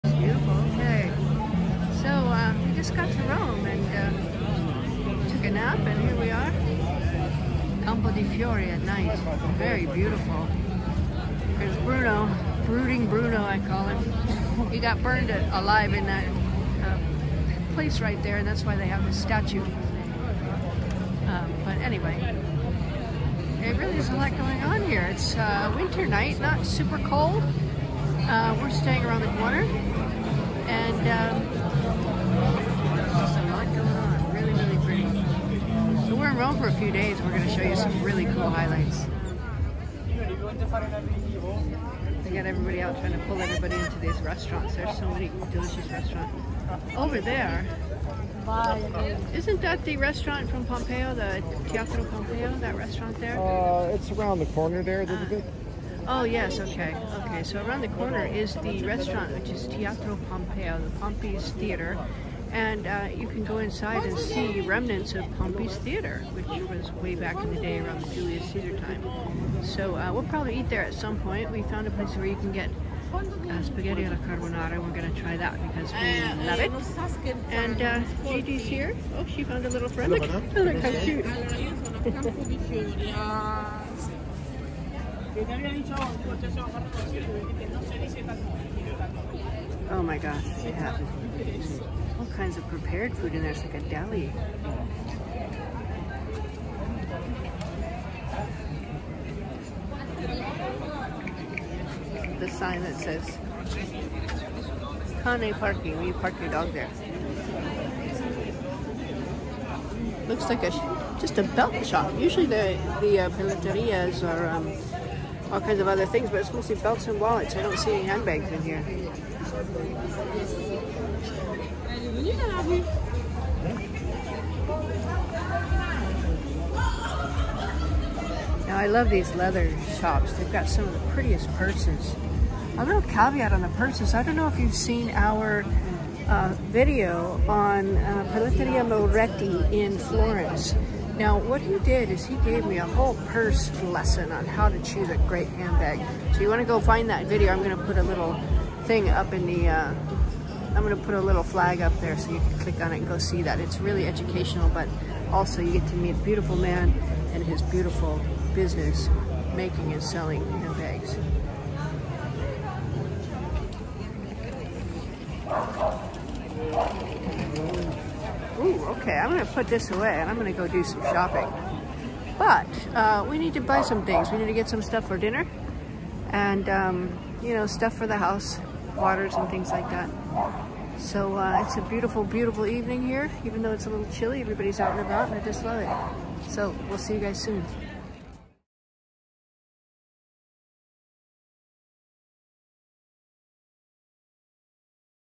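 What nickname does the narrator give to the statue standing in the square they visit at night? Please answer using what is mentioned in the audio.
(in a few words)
Brooding Bruno.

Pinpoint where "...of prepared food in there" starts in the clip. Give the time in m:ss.
1:32.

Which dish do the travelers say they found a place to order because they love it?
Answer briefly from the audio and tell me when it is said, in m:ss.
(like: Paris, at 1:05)
Spaghetti alla carbonara, at 1:13.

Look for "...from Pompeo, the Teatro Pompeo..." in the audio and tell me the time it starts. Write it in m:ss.
0:50.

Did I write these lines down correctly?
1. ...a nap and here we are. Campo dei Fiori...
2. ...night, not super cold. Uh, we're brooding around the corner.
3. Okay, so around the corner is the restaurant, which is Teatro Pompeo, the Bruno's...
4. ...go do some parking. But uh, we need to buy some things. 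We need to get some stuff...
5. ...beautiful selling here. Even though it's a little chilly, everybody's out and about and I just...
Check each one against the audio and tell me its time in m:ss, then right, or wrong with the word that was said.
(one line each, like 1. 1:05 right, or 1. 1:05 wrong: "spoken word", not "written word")
1. 0:05 right
2. 0:26 wrong: "staying", not "brooding"
3. 0:57 wrong: "Pompey", not "Bruno"
4. 2:50 wrong: "shopping", not "parking"
5. 3:02 wrong: "evening", not "selling".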